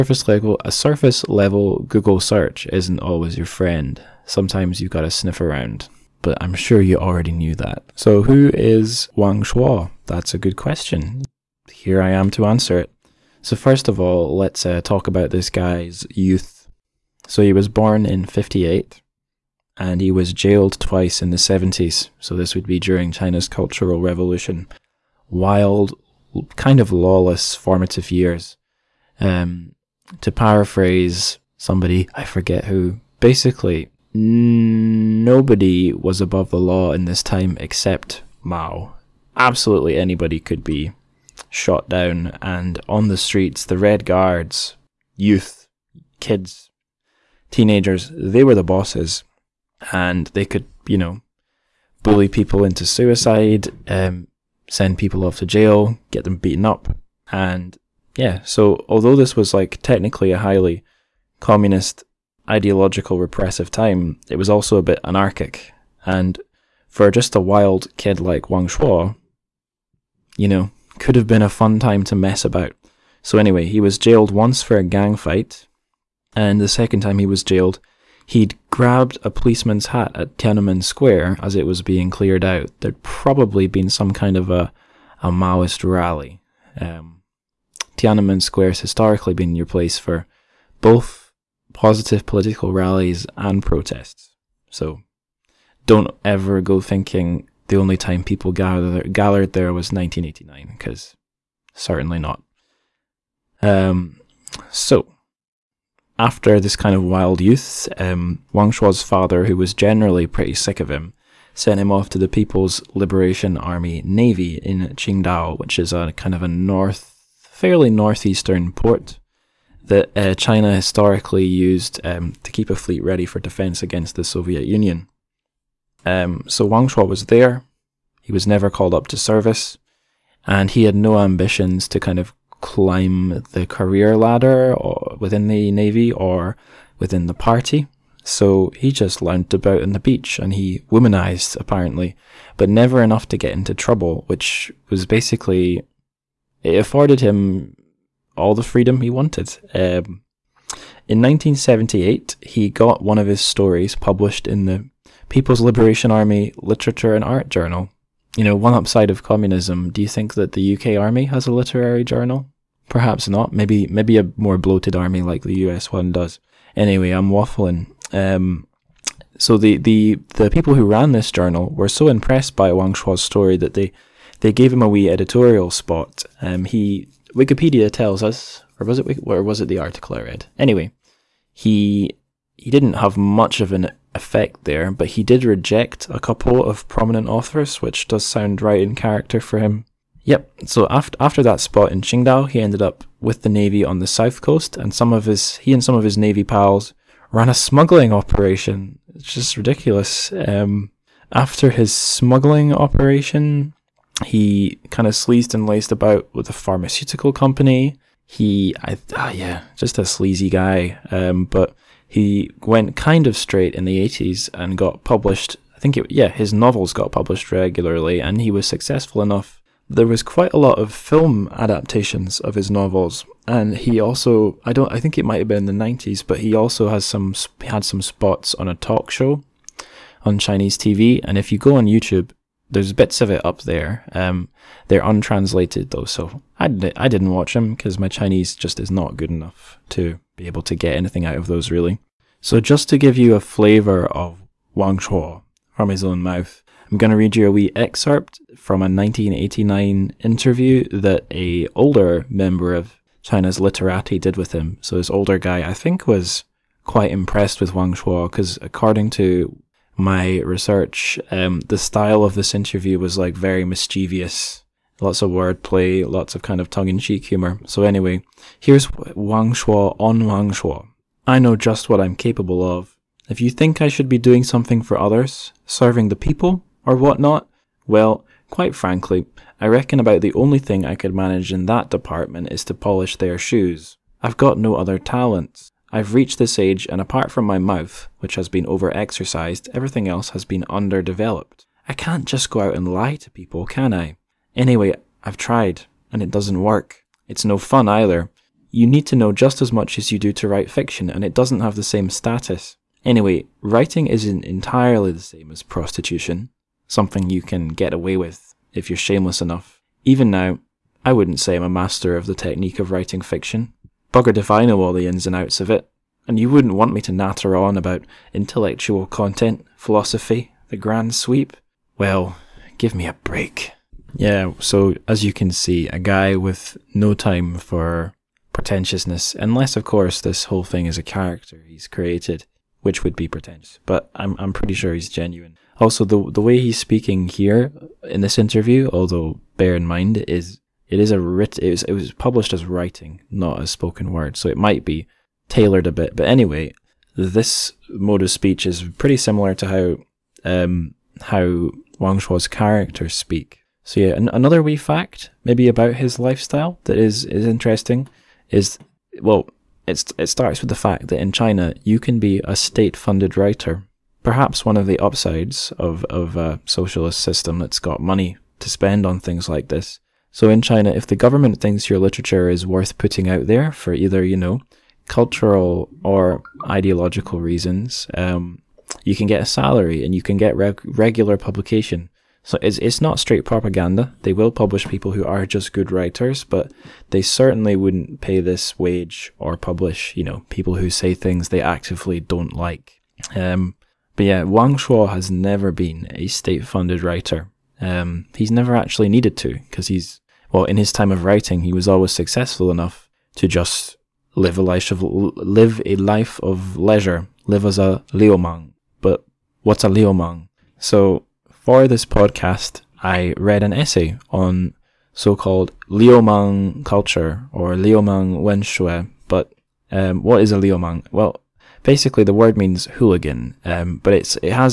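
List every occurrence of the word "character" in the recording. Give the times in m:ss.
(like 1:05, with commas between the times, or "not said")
3:08, 5:31, 5:52.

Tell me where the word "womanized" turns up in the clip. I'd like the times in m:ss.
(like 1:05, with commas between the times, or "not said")
2:20.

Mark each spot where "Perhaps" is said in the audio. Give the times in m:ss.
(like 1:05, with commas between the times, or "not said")
2:42, 6:04.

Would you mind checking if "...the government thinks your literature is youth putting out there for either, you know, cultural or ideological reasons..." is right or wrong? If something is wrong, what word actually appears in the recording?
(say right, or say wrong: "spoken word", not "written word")
wrong: "worth", not "youth".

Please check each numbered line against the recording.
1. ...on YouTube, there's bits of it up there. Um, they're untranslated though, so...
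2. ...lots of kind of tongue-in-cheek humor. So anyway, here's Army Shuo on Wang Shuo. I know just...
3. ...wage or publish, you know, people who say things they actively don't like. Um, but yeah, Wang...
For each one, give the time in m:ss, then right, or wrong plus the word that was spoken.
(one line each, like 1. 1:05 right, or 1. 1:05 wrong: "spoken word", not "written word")
1. 3:51 right
2. 4:26 wrong: "Wang", not "Army"
3. 6:28 right.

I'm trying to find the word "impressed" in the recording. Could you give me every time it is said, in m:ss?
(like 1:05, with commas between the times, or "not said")
2:52, 4:17.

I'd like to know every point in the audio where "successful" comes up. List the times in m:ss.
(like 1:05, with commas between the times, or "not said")
3:38, 6:42.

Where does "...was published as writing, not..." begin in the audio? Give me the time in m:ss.
5:41.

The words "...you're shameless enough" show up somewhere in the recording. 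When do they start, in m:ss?
5:08.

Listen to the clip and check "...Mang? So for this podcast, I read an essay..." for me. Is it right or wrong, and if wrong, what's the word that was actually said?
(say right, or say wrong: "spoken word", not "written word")
right.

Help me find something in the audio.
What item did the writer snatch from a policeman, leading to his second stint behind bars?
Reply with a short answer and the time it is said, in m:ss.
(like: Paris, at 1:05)
A policeman's hat, at 1:19.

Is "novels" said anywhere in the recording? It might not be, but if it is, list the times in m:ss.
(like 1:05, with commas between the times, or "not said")
3:36, 3:42.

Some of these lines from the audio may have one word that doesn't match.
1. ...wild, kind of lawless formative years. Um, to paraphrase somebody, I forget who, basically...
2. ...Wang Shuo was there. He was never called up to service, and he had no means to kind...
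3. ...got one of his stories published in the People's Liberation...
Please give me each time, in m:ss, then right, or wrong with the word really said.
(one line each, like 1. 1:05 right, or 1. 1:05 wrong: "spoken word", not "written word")
1. 0:25 right
2. 2:06 wrong: "ambitions", not "means"
3. 2:32 right.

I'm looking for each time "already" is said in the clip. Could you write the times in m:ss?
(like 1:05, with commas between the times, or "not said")
0:06.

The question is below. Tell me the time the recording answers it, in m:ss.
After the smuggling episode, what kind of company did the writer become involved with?
3:26.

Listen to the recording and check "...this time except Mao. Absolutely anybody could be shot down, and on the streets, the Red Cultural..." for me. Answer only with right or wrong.
wrong.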